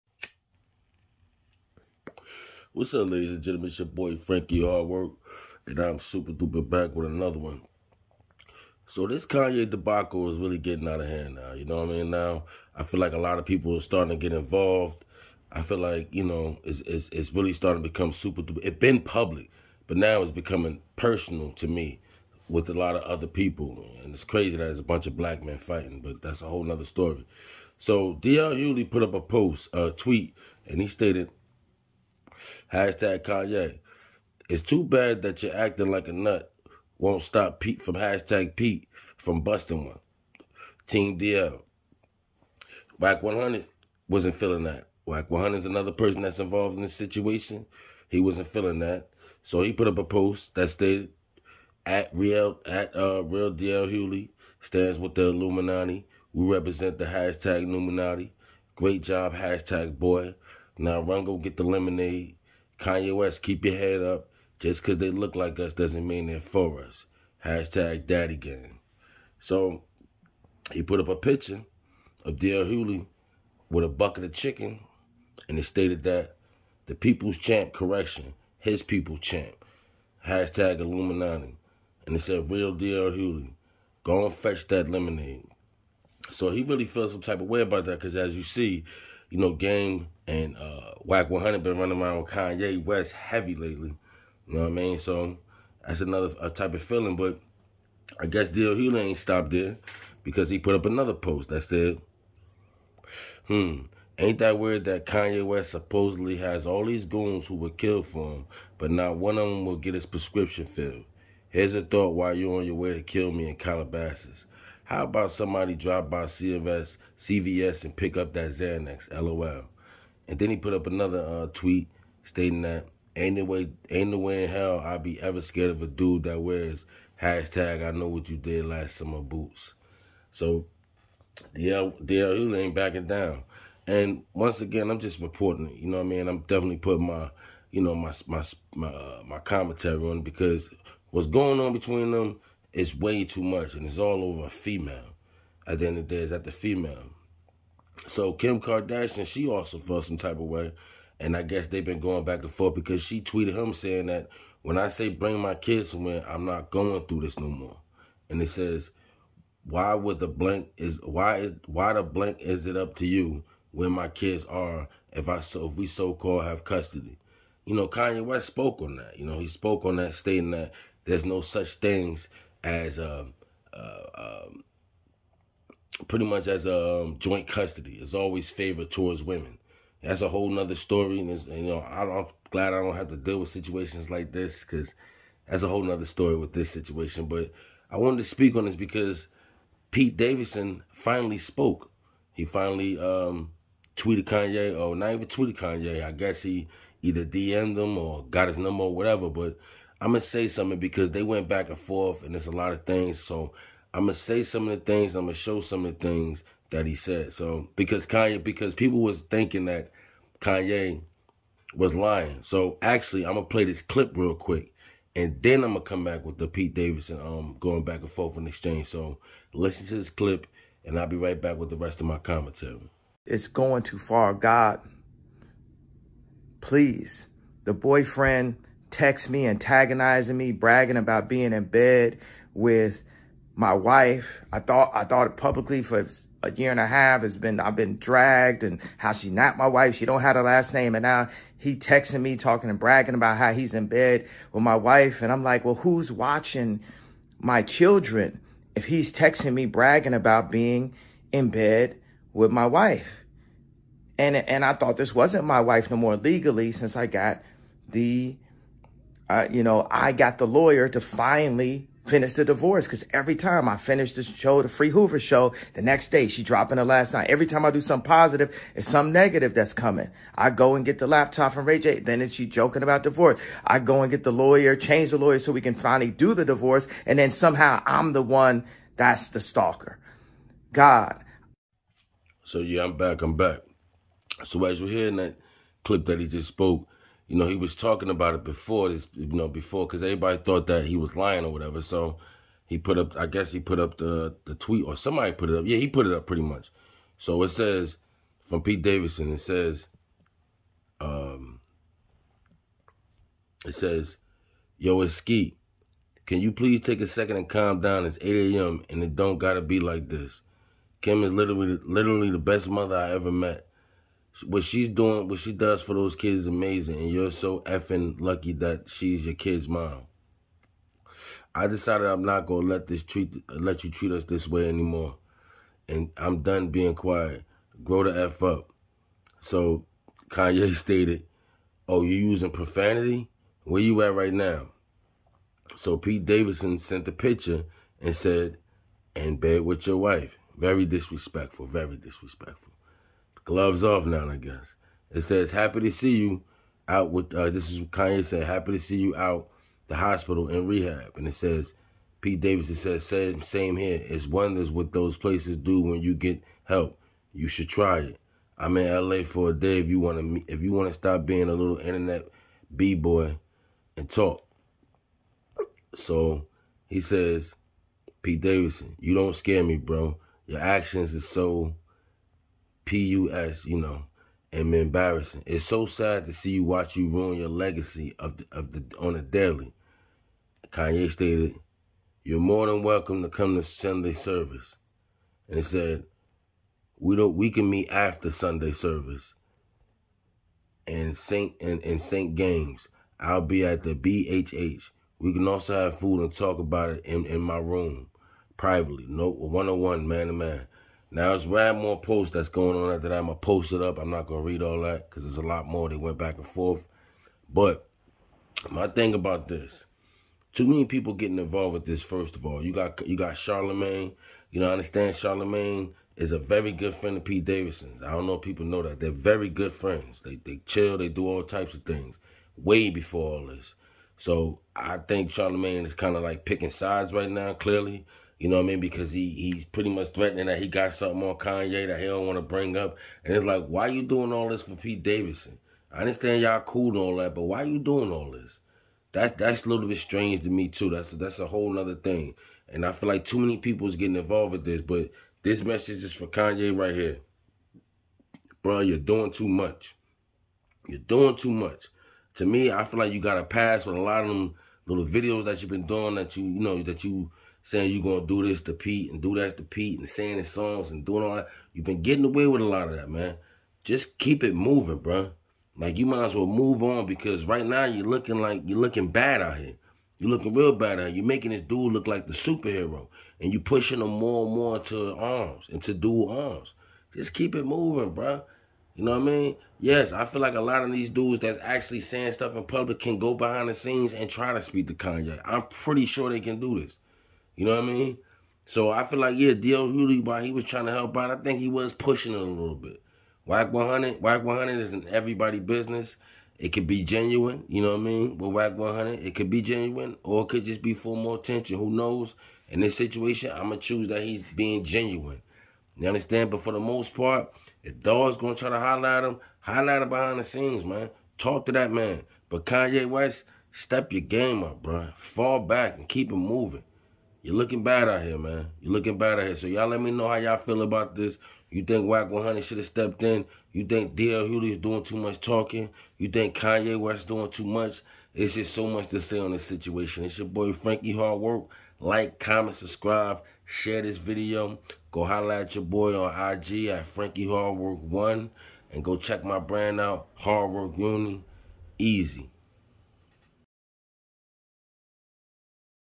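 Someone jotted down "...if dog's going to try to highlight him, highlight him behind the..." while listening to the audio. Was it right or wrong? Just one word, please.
right.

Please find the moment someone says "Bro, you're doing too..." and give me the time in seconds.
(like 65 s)
448 s.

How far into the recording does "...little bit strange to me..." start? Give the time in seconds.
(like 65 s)
439 s.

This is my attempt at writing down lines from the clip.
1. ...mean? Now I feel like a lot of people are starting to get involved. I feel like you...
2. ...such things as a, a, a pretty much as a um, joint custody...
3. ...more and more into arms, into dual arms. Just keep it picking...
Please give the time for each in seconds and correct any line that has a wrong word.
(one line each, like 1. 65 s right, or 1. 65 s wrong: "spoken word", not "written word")
1. 11 s right
2. 171 s right
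3. 474 s wrong: "moving", not "picking".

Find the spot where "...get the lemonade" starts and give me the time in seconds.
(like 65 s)
61 s.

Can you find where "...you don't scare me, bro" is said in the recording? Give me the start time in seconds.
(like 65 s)
368 s.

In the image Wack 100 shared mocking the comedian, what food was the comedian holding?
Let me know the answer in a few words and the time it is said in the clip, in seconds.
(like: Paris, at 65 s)
bucket of chicken, at 73 s.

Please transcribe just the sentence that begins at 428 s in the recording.
Because he he's pretty much threatening that he got something on Kanye that he don't want to bring up.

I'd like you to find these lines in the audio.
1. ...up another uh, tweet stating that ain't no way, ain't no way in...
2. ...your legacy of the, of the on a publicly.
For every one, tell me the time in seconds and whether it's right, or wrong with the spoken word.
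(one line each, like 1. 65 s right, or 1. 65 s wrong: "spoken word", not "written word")
1. 120 s right
2. 377 s wrong: "daily", not "publicly".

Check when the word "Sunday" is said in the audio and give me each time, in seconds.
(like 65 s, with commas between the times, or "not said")
383 s, 388 s.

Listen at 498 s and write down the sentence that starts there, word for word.
With Wack 100, it could be genuine, or it could just be for more attention.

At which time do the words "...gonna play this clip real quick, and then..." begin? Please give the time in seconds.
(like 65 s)
213 s.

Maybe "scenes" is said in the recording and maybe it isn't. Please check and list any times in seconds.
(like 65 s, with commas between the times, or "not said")
483 s, 510 s.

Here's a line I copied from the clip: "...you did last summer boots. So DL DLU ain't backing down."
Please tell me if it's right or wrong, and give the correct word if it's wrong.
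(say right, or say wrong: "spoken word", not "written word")
right.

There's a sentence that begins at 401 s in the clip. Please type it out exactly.
Now it's rad more posts that's going on after that.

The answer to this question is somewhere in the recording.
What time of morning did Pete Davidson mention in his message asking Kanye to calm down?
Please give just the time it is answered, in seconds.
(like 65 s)
308 s.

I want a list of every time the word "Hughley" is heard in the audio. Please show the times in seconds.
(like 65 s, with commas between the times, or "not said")
28 s, 53 s, 72 s, 83 s, 98 s, 489 s.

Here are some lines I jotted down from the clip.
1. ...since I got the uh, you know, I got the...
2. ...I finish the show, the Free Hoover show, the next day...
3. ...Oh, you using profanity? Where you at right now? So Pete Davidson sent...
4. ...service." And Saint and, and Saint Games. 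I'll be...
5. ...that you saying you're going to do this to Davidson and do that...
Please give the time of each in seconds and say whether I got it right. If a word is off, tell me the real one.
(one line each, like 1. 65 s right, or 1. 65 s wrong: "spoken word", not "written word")
1. 256 s right
2. 263 s right
3. 331 s right
4. 388 s right
5. 456 s wrong: "Pete", not "Davidson".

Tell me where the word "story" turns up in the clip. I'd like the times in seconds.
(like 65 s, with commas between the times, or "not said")
26 s, 180 s, 186 s.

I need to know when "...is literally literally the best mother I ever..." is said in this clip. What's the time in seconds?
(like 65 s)
311 s.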